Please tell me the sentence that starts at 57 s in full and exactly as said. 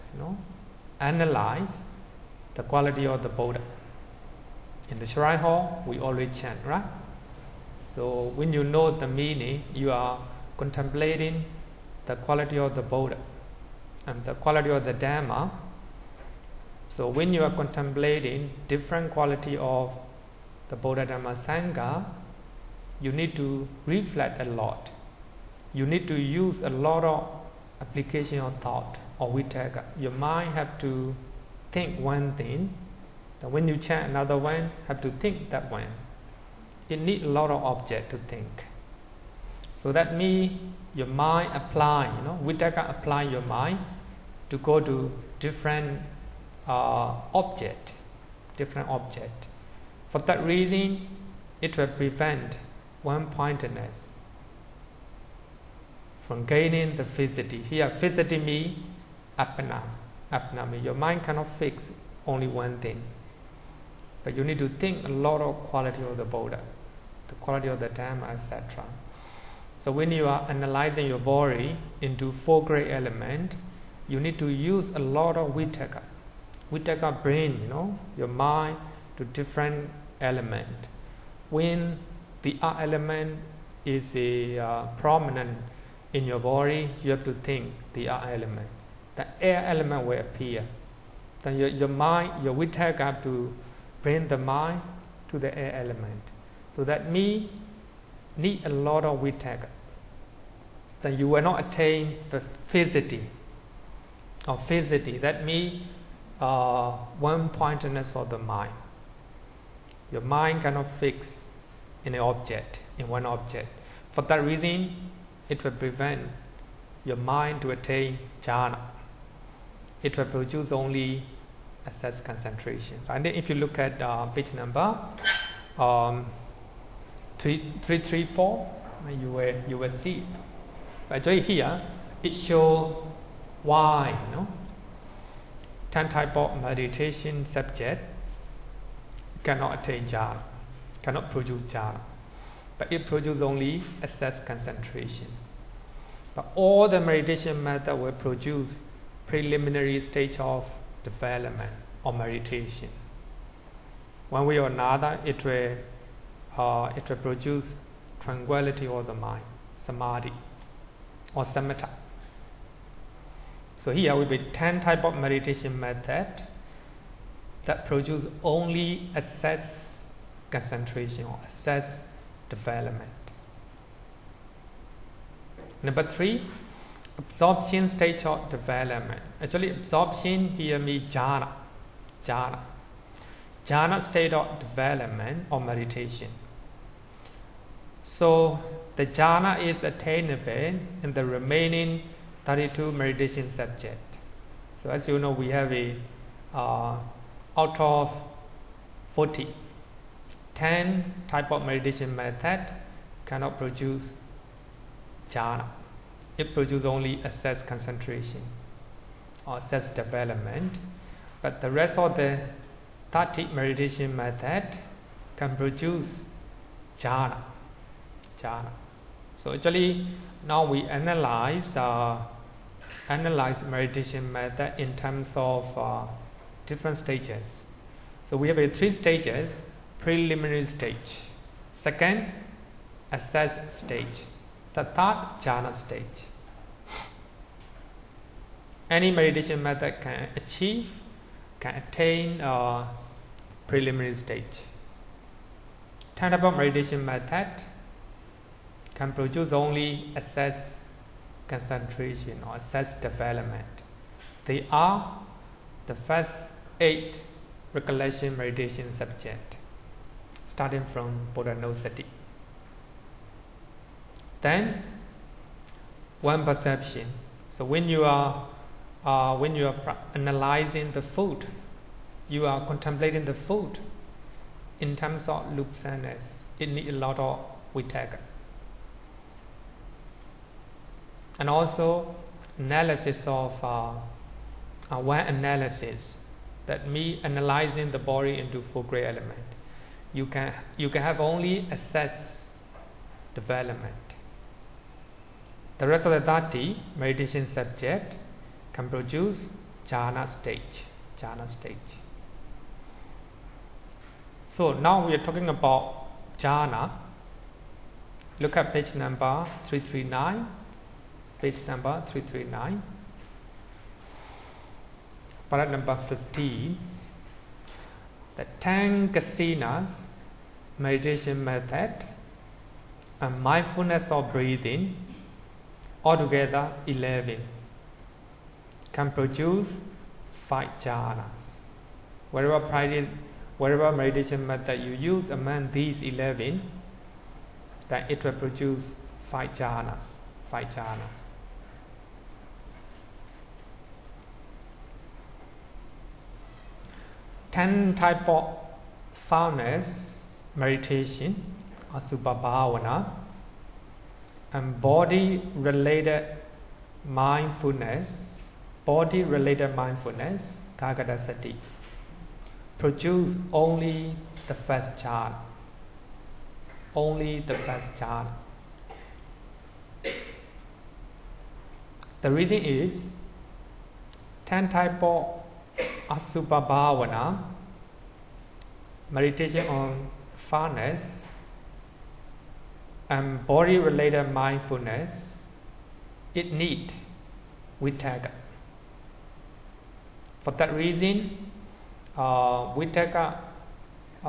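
Here, fixity means appana, appana your mind cannot fix only one thing.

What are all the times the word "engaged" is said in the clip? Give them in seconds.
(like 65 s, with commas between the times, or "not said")
not said.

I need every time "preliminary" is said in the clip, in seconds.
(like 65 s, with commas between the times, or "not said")
149 s, 229 s, 243 s.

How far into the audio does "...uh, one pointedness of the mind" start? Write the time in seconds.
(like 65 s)
106 s.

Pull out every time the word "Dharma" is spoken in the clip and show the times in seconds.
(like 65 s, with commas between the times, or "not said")
14 s, 21 s.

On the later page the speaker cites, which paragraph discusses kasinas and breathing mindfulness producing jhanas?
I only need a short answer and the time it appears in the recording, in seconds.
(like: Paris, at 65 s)
15, at 315 s.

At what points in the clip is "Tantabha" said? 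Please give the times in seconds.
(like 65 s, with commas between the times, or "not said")
246 s.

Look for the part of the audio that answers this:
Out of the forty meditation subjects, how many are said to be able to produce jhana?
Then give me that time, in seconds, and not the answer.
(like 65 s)
192 s.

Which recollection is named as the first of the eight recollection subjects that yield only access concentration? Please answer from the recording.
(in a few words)
Buddhanussati.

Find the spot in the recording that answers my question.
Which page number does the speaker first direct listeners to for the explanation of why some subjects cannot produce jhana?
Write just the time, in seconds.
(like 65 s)
127 s.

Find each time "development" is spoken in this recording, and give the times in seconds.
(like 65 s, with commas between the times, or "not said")
151 s, 172 s, 178 s, 184 s, 209 s, 253 s, 293 s.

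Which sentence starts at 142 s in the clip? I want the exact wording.
But it produces only assess concentration.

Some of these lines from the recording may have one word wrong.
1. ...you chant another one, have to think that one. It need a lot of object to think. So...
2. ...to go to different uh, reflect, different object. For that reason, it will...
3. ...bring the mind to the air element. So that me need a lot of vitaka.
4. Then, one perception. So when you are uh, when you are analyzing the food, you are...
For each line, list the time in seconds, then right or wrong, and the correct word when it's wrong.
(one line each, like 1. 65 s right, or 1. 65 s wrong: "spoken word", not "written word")
1. 33 s right
2. 44 s wrong: "object", not "reflect"
3. 94 s right
4. 264 s right.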